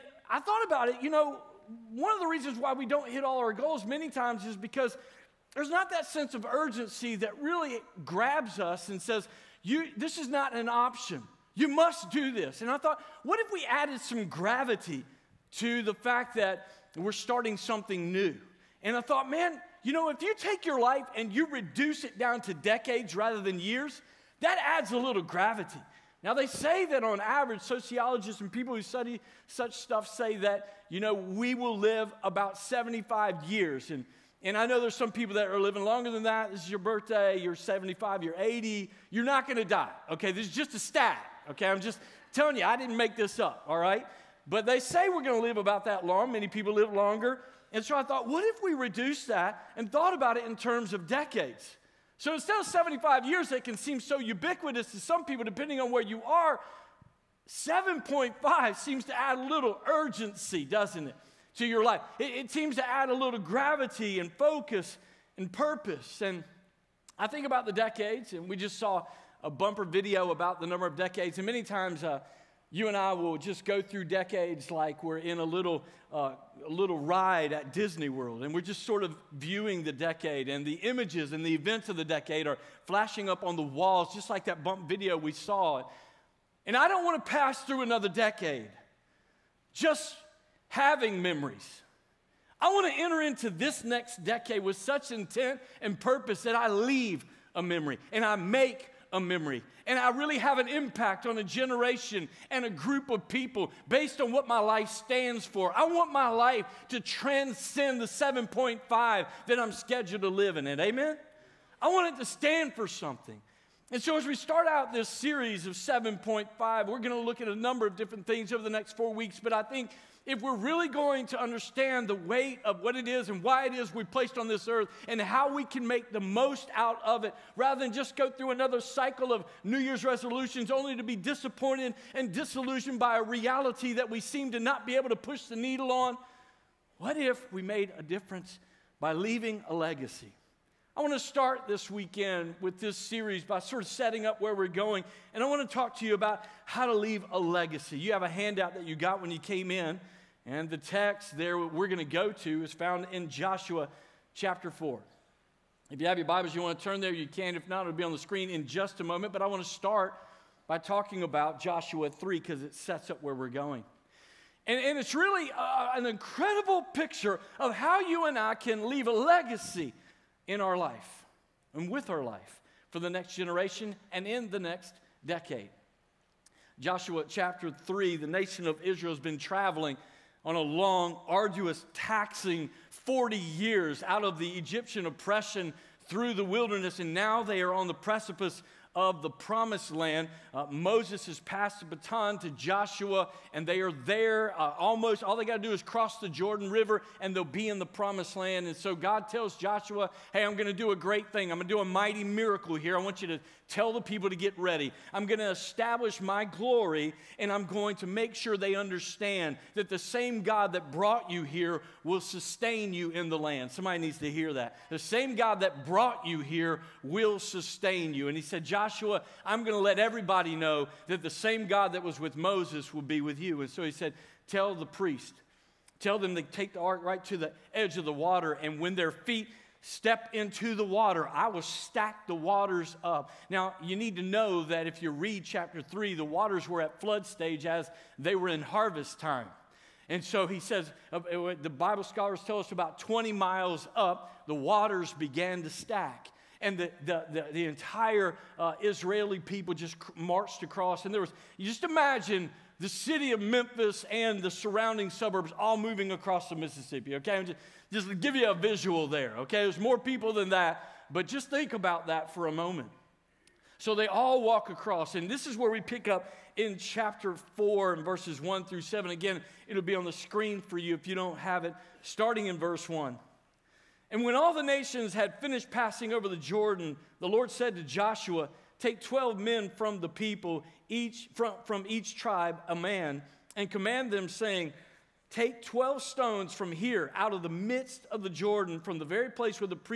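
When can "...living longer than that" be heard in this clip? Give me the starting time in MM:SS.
00:35.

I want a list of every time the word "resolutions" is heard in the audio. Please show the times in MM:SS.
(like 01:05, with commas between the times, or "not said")
02:10.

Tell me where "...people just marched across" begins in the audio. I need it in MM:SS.
04:09.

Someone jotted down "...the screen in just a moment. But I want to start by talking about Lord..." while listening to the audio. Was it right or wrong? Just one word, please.
wrong.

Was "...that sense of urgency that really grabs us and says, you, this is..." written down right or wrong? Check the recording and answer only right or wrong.
right.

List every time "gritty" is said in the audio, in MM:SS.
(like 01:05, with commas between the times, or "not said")
not said.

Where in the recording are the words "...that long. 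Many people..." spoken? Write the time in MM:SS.
00:45.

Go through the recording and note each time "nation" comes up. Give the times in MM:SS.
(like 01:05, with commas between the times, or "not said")
02:58, 04:34.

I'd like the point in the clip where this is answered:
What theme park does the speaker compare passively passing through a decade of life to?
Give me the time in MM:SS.
01:17.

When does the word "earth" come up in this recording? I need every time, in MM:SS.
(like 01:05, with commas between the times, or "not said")
02:04.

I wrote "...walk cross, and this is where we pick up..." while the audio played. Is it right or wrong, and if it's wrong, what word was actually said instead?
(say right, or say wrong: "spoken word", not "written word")
wrong: "across", not "cross".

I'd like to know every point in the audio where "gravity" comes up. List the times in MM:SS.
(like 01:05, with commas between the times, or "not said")
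00:14, 00:25, 01:03.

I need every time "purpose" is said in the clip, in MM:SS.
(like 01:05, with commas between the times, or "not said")
01:05, 01:35.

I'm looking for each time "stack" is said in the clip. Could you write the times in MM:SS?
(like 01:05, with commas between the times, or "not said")
03:51, 04:05.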